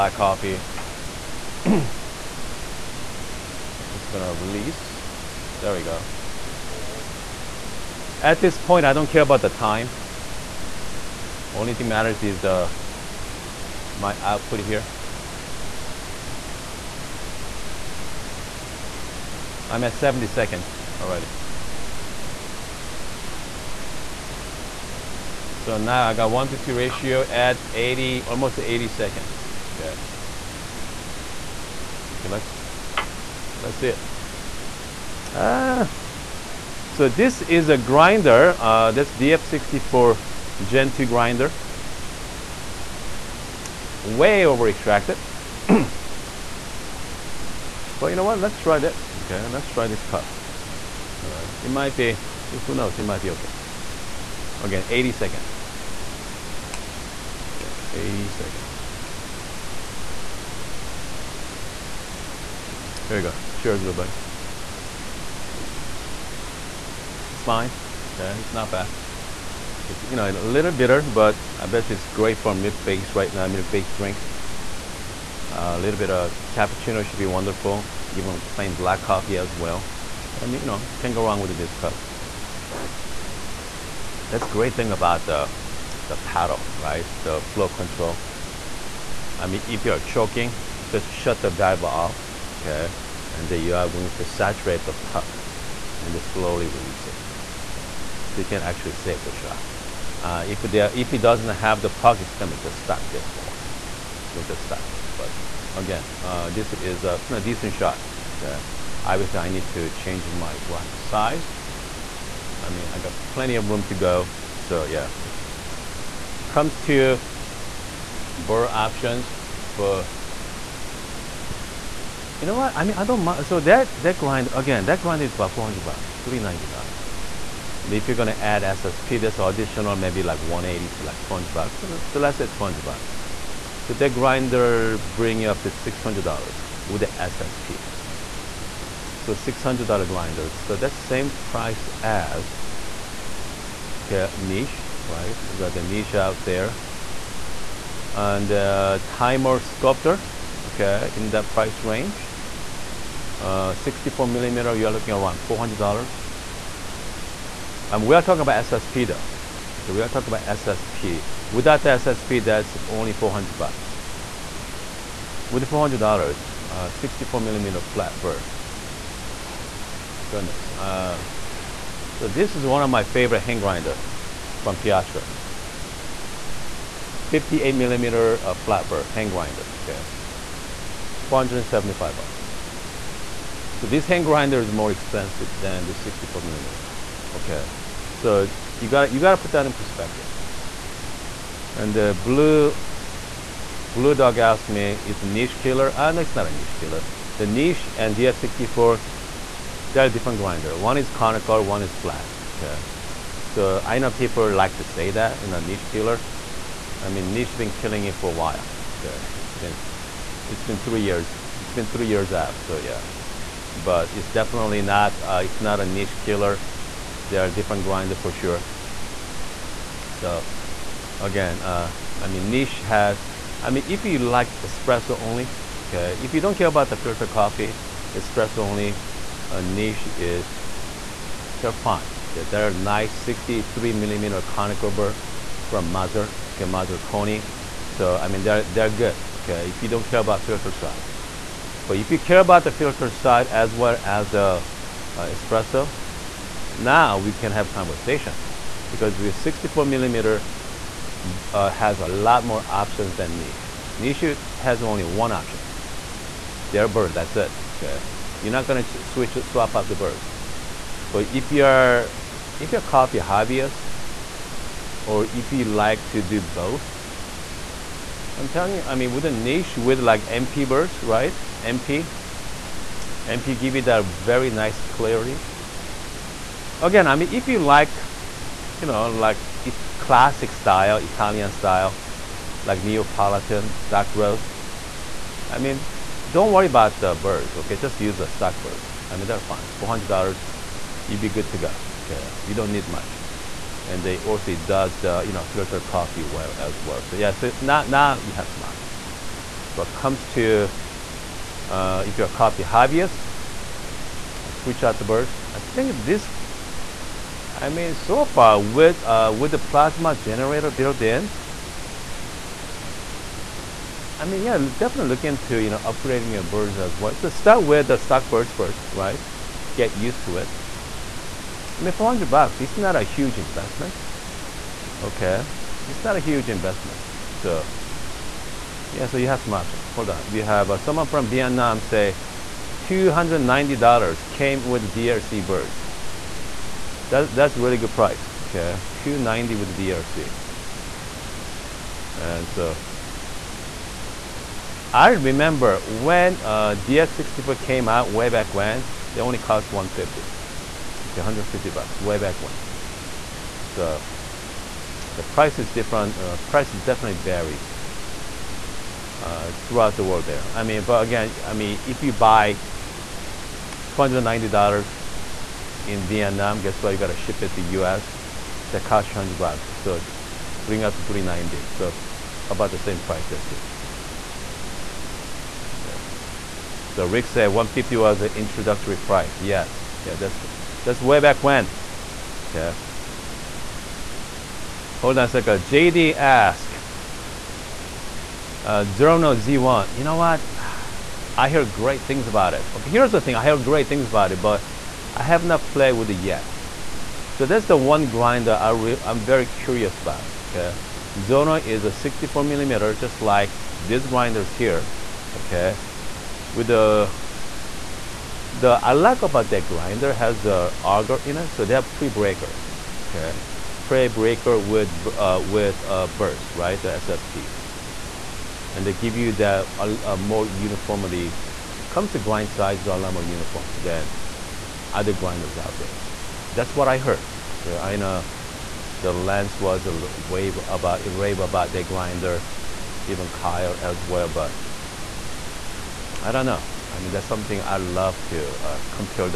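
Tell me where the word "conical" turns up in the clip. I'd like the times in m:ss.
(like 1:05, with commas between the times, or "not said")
3:21, 3:54.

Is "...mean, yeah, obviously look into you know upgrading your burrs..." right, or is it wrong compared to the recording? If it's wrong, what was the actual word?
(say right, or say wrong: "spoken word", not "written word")
wrong: "definitely", not "obviously".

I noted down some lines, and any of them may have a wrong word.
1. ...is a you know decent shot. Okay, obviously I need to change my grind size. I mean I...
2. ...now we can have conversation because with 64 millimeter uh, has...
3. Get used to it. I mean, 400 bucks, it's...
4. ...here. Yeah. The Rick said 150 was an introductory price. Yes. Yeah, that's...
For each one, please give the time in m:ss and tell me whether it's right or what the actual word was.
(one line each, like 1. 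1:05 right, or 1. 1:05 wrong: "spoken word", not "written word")
1. 1:46 right
2. 4:06 right
3. 5:19 right
4. 6:13 right.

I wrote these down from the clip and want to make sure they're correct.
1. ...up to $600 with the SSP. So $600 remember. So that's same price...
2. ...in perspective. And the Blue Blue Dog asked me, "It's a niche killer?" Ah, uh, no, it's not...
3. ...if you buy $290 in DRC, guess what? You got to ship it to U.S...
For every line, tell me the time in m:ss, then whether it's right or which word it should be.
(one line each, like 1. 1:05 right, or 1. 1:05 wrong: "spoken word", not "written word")
1. 2:15 wrong: "grinder", not "remember"
2. 3:09 right
3. 6:01 wrong: "Vietnam", not "DRC".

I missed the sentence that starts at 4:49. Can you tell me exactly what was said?
$400, you'd be good to go, okay?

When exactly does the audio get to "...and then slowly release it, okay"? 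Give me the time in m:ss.
1:35.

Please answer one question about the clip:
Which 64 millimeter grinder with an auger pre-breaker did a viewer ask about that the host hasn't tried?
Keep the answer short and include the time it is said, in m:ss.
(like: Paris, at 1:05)
Zerno Z1, at 6:28.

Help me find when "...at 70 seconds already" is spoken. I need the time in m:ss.
0:19.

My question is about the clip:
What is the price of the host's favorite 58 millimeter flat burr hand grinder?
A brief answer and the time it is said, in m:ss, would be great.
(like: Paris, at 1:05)
$475, at 3:01.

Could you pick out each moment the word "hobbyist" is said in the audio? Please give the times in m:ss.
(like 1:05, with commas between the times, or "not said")
4:23, 5:02.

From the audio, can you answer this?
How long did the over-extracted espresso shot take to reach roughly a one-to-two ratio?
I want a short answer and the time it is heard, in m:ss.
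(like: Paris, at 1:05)
80 seconds, at 0:28.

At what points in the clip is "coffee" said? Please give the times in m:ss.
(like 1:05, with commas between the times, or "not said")
0:00, 1:19, 3:47, 4:22, 4:55, 5:02.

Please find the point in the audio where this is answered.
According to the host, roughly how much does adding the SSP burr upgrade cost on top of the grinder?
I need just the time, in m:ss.
2:10.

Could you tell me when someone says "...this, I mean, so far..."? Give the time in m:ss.
5:06.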